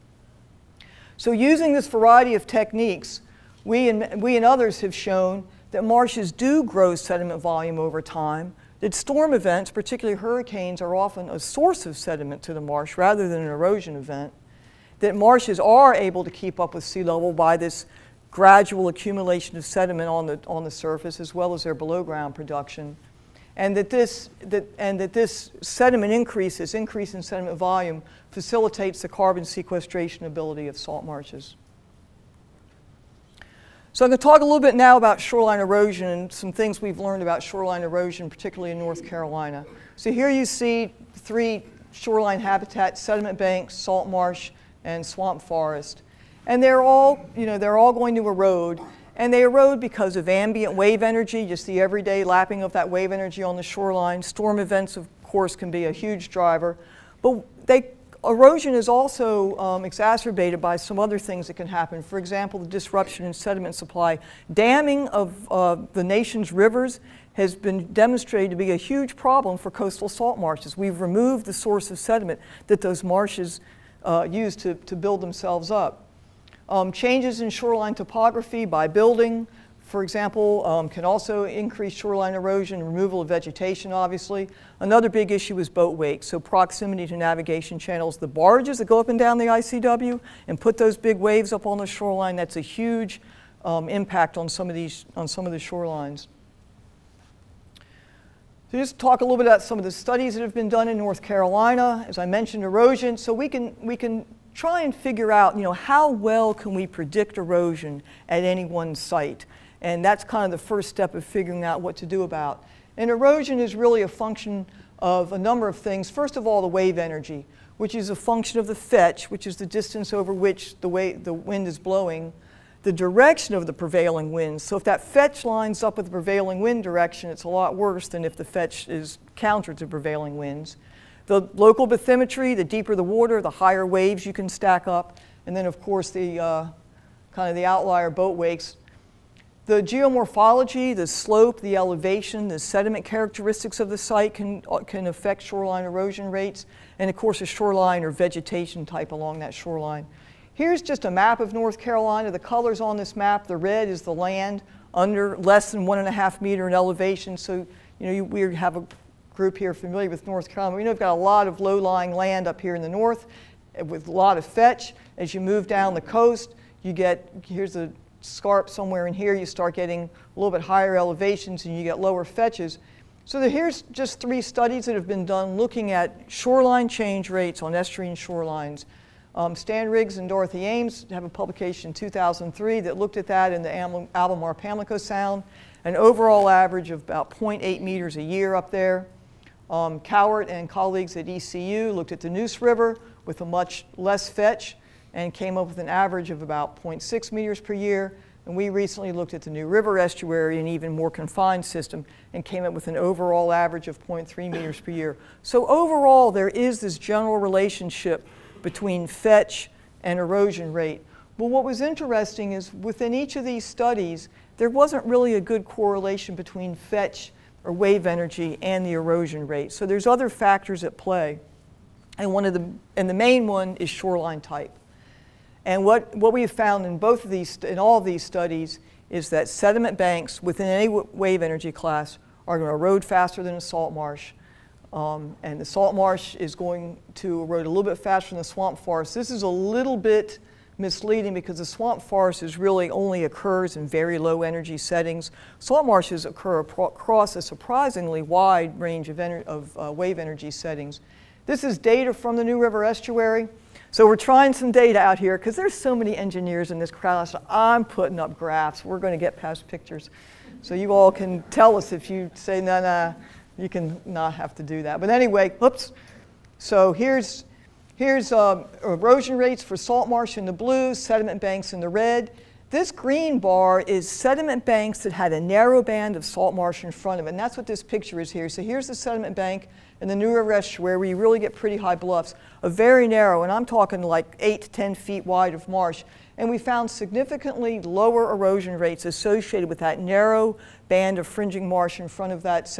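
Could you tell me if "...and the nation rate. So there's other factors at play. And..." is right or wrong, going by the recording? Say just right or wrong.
wrong.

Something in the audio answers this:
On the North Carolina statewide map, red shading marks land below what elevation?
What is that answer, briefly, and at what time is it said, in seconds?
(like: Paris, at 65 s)
1.5 meters, at 155 s.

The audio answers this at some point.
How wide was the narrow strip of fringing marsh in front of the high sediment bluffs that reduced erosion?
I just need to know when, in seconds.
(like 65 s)
284 s.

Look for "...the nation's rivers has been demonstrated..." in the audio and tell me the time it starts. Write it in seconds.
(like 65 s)
65 s.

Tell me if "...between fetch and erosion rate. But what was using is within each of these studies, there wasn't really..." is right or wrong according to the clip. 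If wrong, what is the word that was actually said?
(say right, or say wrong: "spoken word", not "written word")
wrong: "interesting", not "using".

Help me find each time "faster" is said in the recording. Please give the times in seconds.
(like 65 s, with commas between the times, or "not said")
233 s, 237 s.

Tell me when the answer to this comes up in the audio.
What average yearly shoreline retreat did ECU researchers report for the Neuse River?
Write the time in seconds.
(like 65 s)
196 s.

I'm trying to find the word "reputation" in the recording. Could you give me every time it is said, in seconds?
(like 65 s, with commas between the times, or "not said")
not said.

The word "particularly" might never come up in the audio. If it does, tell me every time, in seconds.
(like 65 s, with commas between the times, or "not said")
9 s, 38 s.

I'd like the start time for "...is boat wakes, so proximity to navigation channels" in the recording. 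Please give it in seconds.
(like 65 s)
85 s.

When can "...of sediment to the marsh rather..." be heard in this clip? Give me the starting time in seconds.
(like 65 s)
11 s.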